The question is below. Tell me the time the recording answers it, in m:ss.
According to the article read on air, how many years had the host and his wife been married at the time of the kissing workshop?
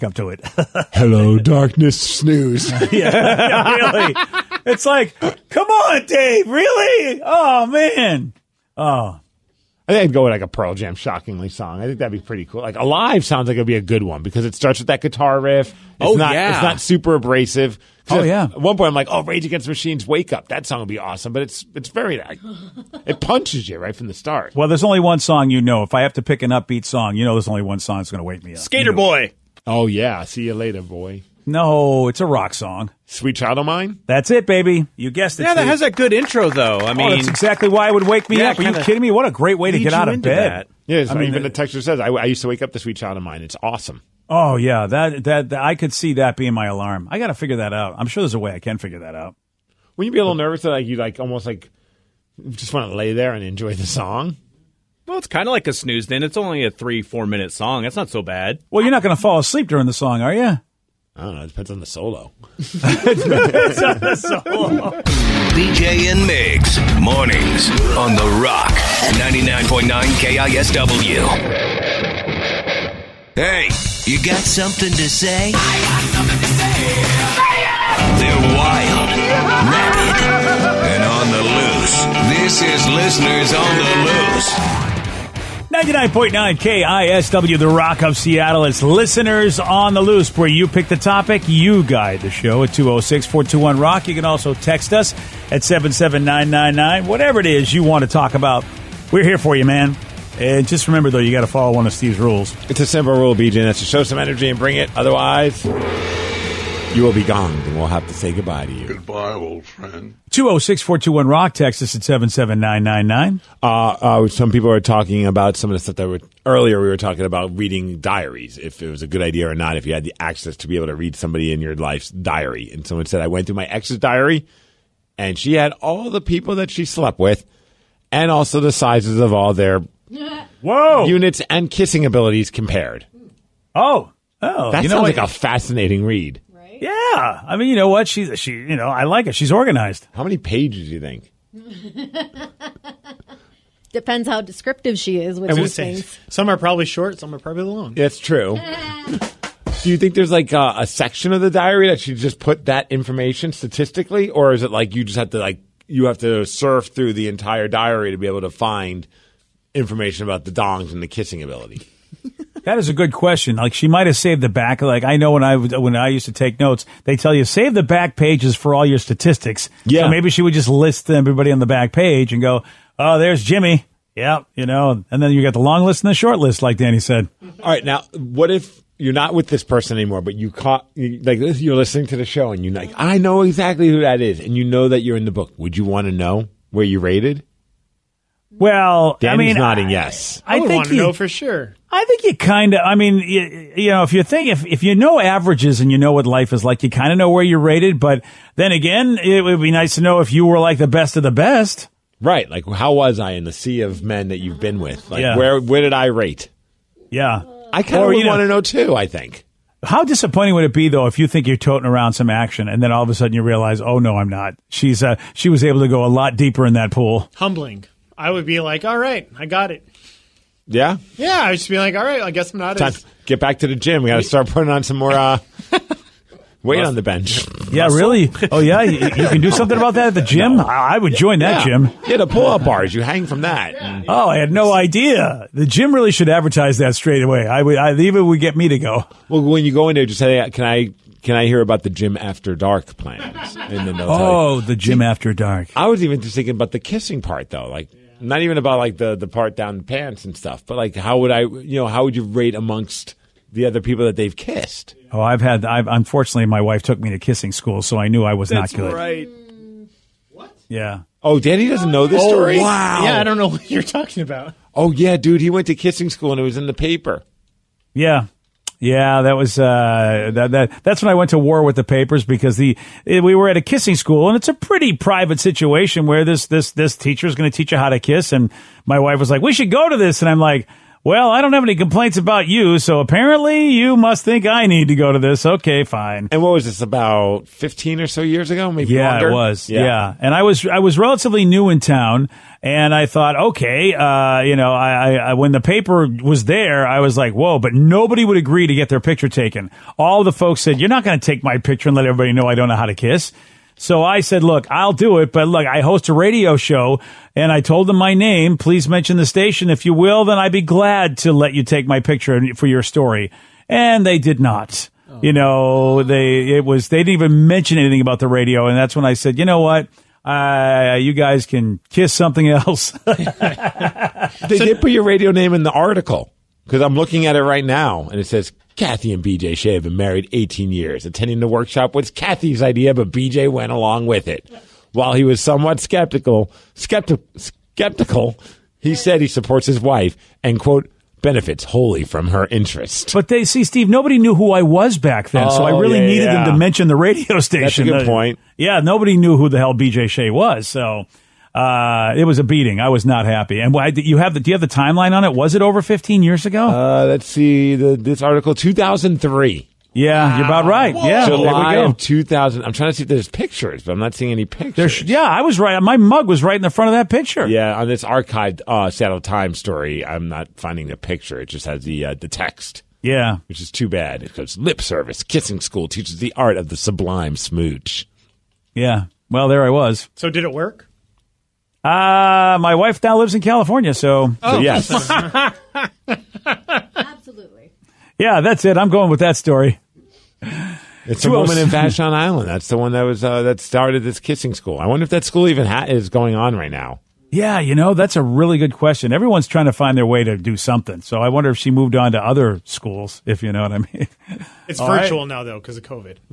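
5:30.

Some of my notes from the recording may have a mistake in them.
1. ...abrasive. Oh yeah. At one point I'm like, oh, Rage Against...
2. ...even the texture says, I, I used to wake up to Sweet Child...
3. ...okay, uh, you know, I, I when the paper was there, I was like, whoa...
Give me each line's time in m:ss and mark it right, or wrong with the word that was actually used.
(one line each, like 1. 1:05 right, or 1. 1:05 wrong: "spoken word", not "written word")
1. 0:17 right
2. 0:41 right
3. 4:53 right.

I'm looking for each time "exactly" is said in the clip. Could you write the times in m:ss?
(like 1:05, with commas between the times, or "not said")
0:37, 3:03.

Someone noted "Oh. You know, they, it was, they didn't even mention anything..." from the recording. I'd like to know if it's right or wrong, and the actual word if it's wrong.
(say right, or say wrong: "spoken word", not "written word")
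right.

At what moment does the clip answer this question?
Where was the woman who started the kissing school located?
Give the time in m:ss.
6:31.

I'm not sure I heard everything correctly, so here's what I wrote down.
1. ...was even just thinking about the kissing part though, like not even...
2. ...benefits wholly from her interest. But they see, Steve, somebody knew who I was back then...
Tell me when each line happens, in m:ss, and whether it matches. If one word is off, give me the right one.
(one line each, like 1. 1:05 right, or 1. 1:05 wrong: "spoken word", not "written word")
1. 4:05 right
2. 5:41 wrong: "nobody", not "somebody".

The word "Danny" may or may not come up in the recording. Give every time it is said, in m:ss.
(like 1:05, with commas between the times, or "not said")
2:56, 3:09.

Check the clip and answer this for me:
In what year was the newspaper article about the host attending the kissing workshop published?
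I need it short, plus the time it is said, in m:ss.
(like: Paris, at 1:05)
2003, at 5:58.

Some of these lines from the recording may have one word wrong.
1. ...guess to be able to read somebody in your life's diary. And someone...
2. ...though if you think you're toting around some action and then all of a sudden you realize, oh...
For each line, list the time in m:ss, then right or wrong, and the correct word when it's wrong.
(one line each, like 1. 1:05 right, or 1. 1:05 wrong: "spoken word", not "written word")
1. 2:00 wrong: "access", not "guess"
2. 3:30 right.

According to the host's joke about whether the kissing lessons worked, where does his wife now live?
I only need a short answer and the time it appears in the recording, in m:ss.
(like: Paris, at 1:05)
California, at 6:23.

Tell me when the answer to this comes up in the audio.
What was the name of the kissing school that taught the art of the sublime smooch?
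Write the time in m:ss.
6:14.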